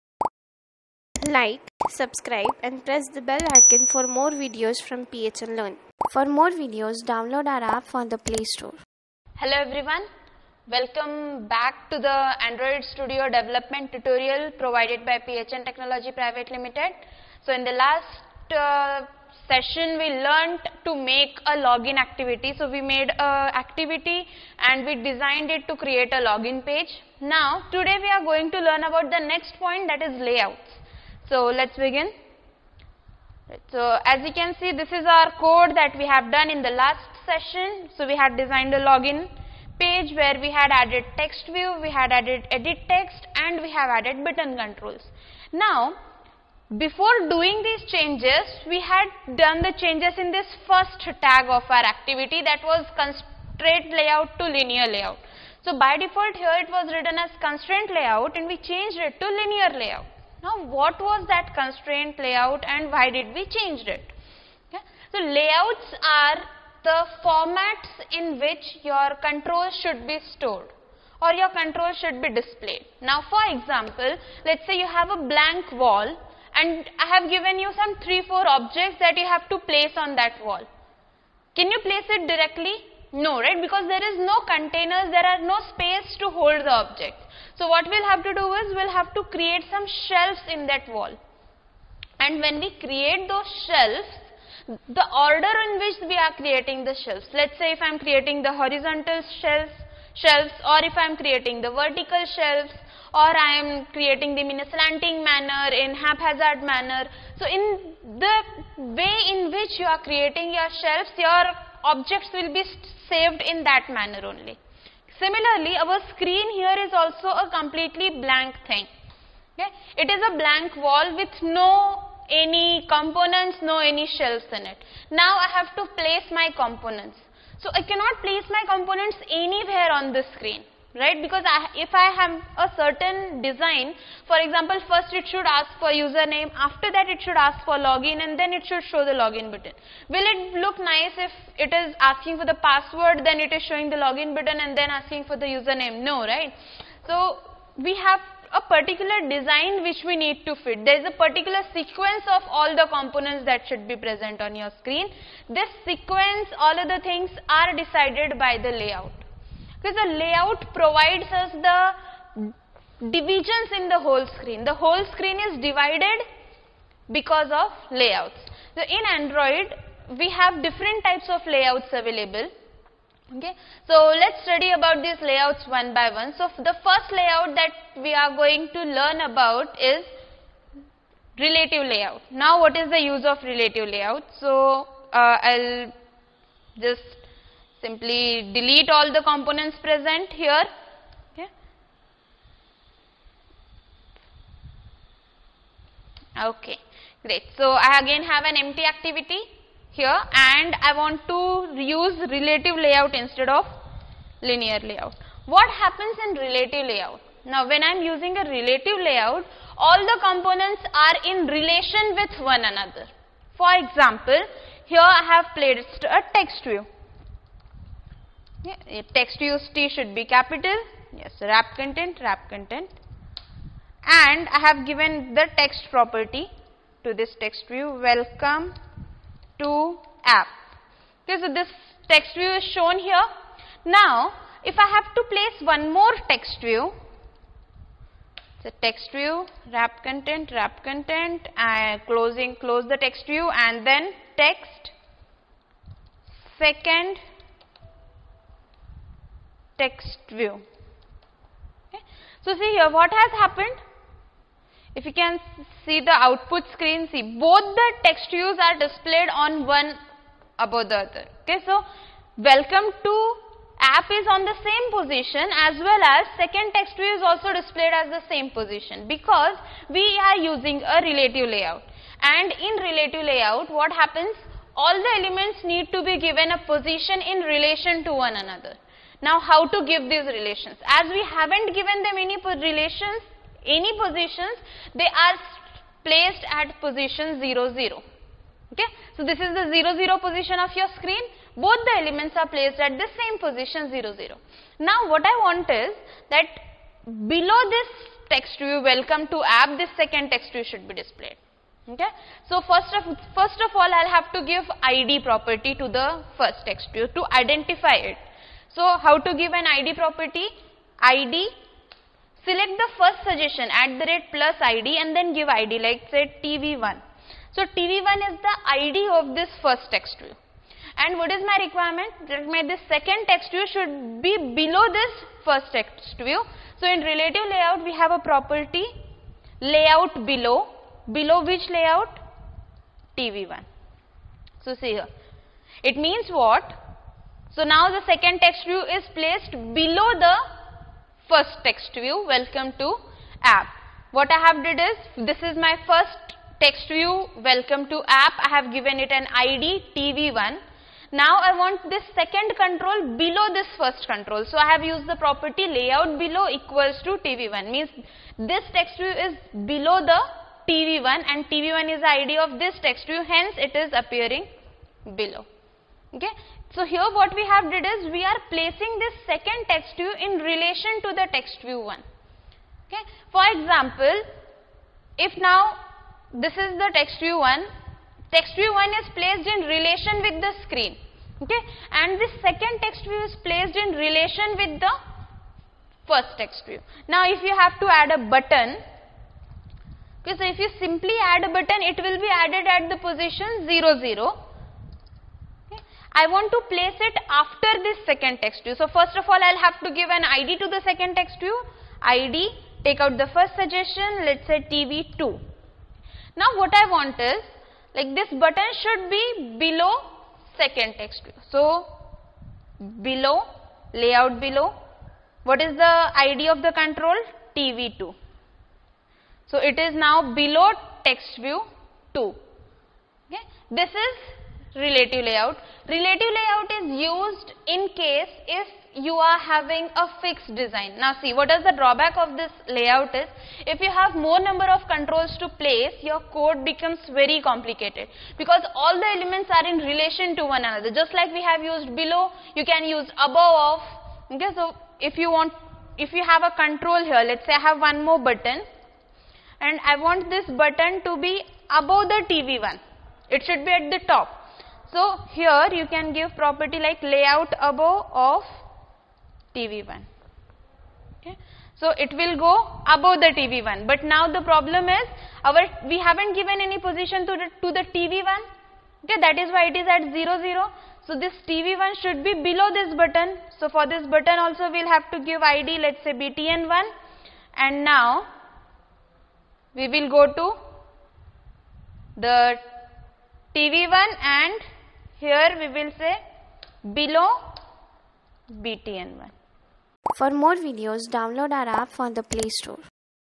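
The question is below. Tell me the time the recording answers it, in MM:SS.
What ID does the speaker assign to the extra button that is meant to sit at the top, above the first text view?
07:55.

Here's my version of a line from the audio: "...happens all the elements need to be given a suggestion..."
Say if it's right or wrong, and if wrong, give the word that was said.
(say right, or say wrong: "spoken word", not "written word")
wrong: "position", not "suggestion".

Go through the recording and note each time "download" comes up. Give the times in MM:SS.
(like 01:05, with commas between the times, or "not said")
00:07, 08:11.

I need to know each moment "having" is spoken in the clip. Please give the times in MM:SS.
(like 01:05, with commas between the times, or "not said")
07:09.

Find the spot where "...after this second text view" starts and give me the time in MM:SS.
06:37.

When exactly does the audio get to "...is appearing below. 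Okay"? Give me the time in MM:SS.
06:03.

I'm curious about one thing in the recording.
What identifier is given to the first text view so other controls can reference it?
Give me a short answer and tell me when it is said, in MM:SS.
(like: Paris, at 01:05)
tv1, at 05:15.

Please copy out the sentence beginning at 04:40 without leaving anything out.
As we haven't given them any relations, any positions, they are placed at position 0, 0.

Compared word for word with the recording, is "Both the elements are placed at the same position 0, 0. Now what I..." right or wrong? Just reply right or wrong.
right.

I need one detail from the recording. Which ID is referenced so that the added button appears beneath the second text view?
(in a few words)
TV2.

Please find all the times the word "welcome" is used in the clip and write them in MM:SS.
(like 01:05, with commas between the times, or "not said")
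00:10, 03:47, 04:22, 04:58, 05:42, 05:47.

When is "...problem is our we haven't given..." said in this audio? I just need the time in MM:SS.
07:44.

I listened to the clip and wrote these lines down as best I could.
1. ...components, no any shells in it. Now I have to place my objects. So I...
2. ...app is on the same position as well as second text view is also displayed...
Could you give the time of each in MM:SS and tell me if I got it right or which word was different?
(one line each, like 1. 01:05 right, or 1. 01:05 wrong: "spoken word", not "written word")
1. 02:02 wrong: "components", not "objects"
2. 04:23 right.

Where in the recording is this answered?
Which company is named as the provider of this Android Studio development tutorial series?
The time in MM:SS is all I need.
00:15.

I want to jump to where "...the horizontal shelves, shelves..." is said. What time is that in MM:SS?
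01:38.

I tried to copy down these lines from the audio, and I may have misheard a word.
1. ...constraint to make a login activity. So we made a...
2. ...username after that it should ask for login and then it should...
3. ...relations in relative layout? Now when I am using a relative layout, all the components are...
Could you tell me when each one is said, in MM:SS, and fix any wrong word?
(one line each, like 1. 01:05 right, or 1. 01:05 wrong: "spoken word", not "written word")
1. 00:20 wrong: "learnt", not "constraint"
2. 02:15 right
3. 03:25 wrong: "happens", not "relations".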